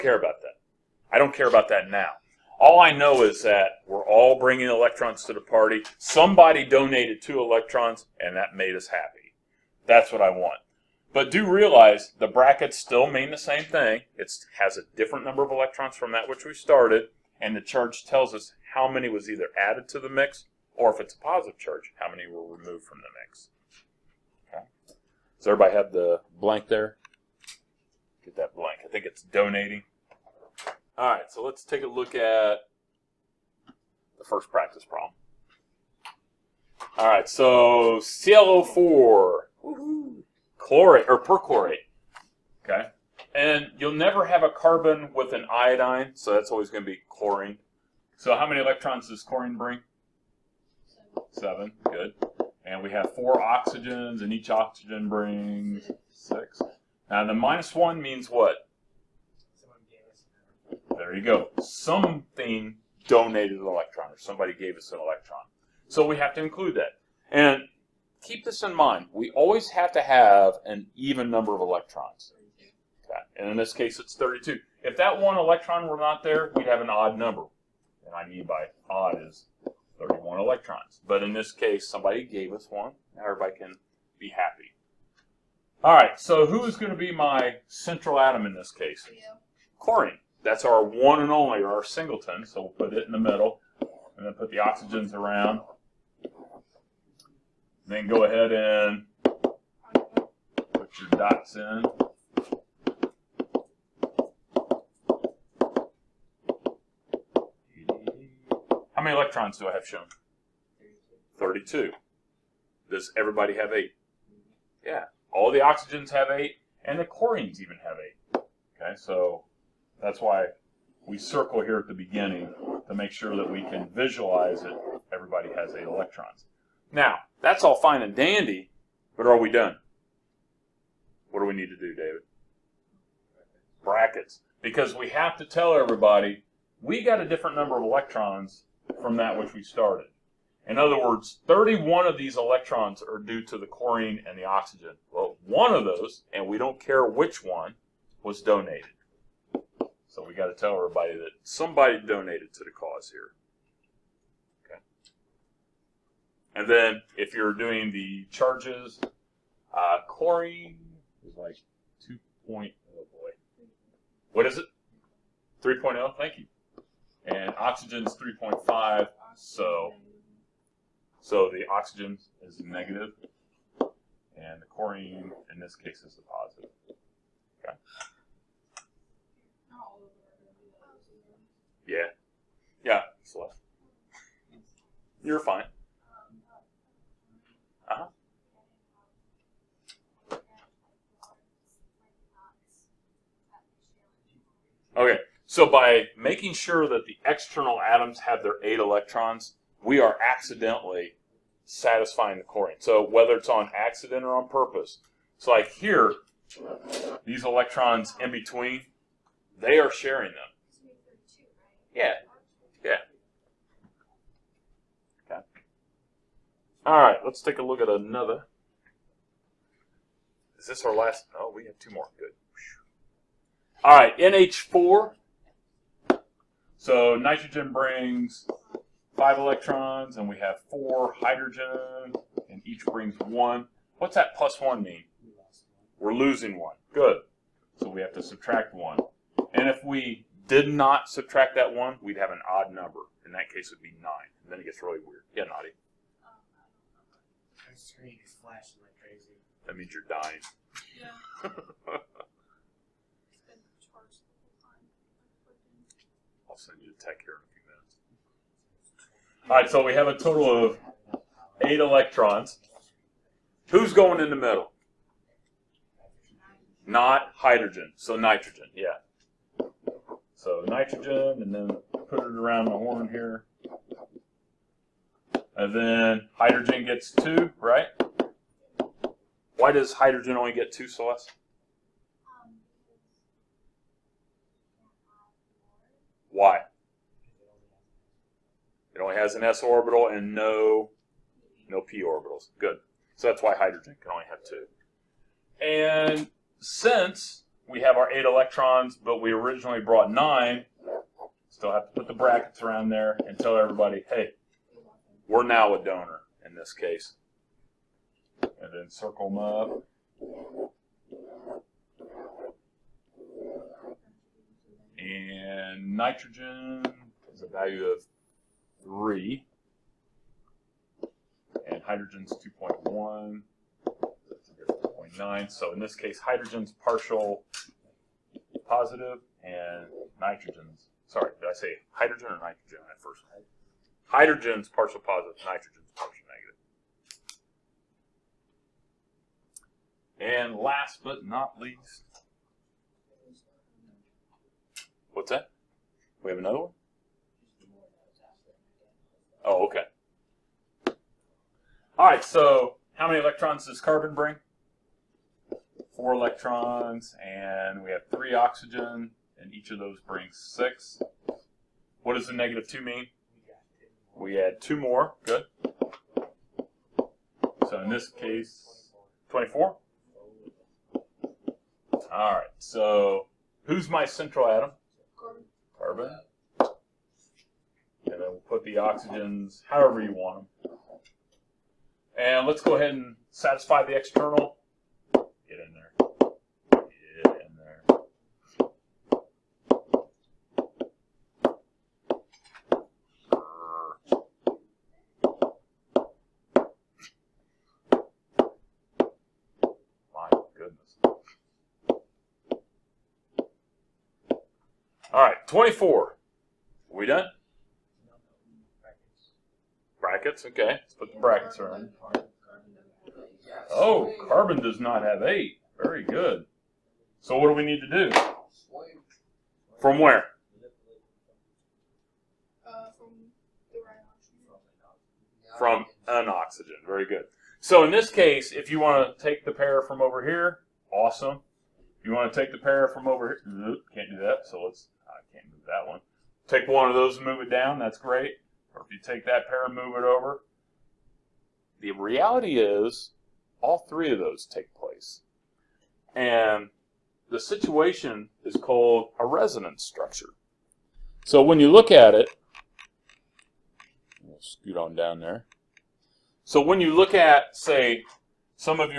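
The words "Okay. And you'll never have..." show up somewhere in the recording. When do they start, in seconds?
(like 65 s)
42 s.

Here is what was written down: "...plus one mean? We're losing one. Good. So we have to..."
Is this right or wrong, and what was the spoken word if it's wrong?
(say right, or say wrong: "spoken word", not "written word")
right.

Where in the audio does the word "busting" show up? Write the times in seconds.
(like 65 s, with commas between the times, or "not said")
not said.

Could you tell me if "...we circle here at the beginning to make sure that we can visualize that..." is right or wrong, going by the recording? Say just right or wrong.
right.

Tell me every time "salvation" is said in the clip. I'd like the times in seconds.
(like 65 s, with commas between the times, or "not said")
not said.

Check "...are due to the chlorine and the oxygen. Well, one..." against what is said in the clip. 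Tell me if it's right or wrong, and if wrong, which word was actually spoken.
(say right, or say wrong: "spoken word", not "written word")
right.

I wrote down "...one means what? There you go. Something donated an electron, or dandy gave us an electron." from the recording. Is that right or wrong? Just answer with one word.
wrong.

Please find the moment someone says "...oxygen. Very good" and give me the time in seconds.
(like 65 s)
426 s.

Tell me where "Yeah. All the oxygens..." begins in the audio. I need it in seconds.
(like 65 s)
114 s.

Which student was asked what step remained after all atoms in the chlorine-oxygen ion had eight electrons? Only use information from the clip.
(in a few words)
David.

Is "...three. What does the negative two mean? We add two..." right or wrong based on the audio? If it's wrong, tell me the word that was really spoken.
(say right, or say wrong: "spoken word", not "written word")
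wrong: "six", not "three".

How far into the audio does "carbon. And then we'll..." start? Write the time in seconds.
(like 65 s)
375 s.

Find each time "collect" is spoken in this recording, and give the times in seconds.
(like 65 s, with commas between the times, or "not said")
not said.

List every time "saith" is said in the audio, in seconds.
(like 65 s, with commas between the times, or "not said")
not said.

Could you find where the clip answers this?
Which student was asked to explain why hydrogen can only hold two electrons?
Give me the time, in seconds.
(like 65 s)
280 s.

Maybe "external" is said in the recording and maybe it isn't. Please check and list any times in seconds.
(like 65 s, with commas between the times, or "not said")
197 s, 383 s.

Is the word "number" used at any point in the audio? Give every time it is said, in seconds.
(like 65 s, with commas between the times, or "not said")
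15 s, 71 s, 77 s, 137 s, 242 s.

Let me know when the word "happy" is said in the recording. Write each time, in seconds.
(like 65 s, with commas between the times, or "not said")
8 s, 84 s.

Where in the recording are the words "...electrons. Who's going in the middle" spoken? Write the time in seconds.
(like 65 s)
261 s.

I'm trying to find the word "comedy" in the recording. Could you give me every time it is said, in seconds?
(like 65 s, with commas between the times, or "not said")
not said.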